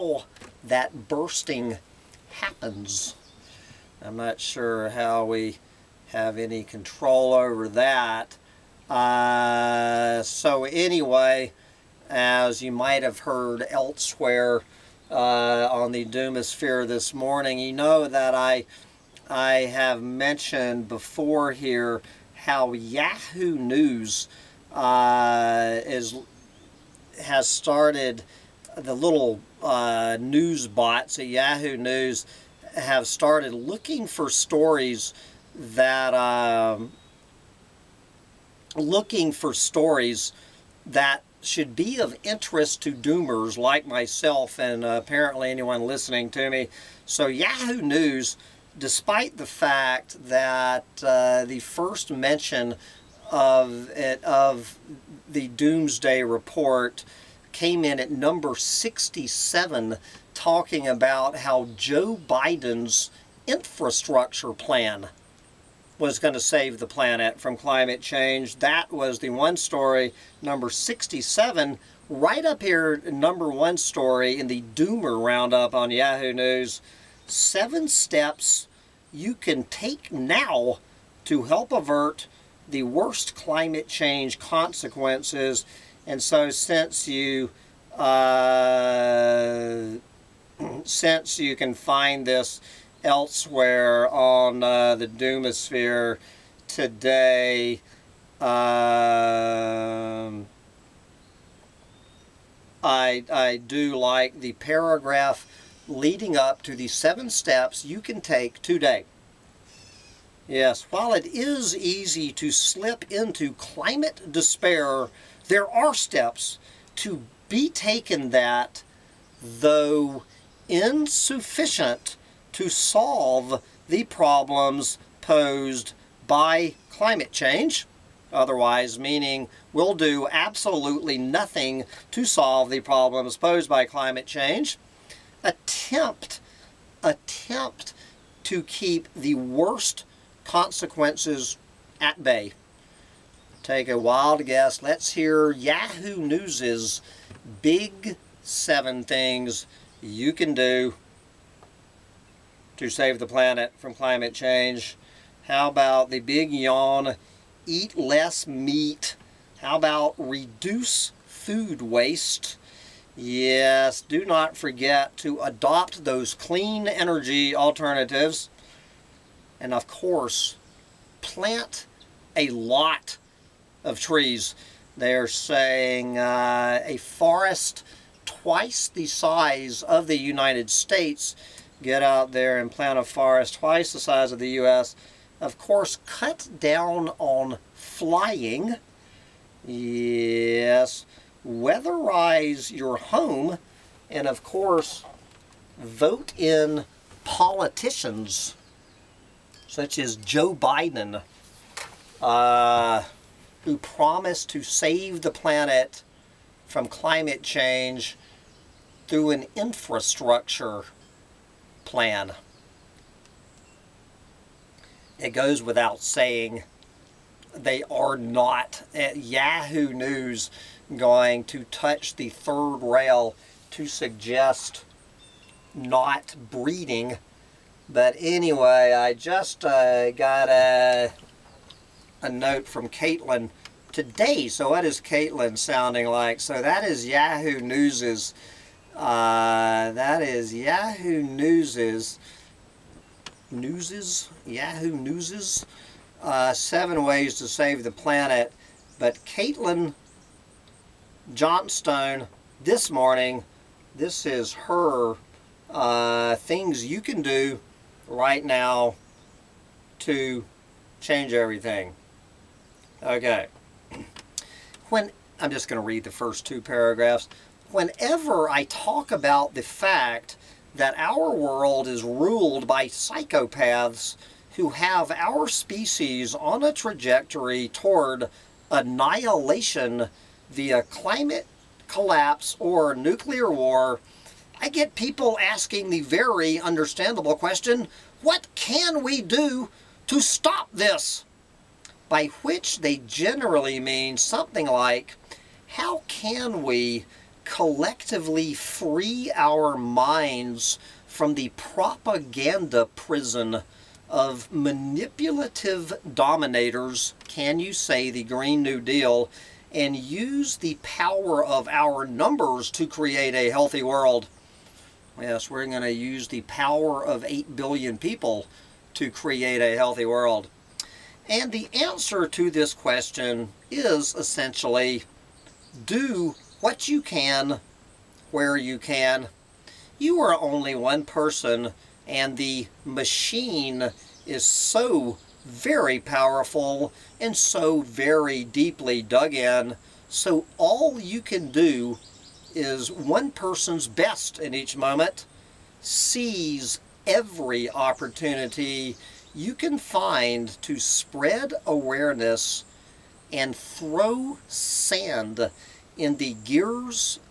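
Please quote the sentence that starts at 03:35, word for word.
It goes without saying they are not.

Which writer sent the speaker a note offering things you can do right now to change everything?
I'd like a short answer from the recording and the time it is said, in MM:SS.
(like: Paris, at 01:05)
Caitlin Johnstone, at 04:09.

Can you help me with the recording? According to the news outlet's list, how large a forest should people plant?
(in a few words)
Twice the size of the United States.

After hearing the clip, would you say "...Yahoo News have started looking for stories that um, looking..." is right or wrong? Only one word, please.
right.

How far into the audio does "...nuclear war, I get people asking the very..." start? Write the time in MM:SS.
04:42.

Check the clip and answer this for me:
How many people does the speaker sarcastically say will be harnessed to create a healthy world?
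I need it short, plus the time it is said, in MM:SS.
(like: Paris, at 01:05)
8 billion, at 05:17.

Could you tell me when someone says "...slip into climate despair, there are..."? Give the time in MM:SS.
01:52.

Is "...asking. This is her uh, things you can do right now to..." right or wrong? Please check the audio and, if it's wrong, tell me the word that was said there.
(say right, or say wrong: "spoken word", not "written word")
wrong: "morning", not "asking".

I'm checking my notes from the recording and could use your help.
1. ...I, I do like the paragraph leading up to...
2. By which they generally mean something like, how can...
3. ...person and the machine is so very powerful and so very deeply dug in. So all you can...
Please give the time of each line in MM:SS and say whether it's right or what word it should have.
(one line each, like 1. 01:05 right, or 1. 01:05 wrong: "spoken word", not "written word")
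1. 01:42 right
2. 04:52 right
3. 05:31 right.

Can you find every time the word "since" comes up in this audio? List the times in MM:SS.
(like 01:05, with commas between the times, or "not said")
01:26, 01:30.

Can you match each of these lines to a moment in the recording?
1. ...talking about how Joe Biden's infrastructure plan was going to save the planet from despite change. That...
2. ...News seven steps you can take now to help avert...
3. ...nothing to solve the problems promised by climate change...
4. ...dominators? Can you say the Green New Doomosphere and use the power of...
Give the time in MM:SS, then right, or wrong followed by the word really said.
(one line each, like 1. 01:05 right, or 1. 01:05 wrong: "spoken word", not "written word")
1. 01:00 wrong: "climate", not "despite"
2. 01:16 right
3. 02:11 wrong: "posed", not "promised"
4. 05:06 wrong: "Deal", not "Doomosphere".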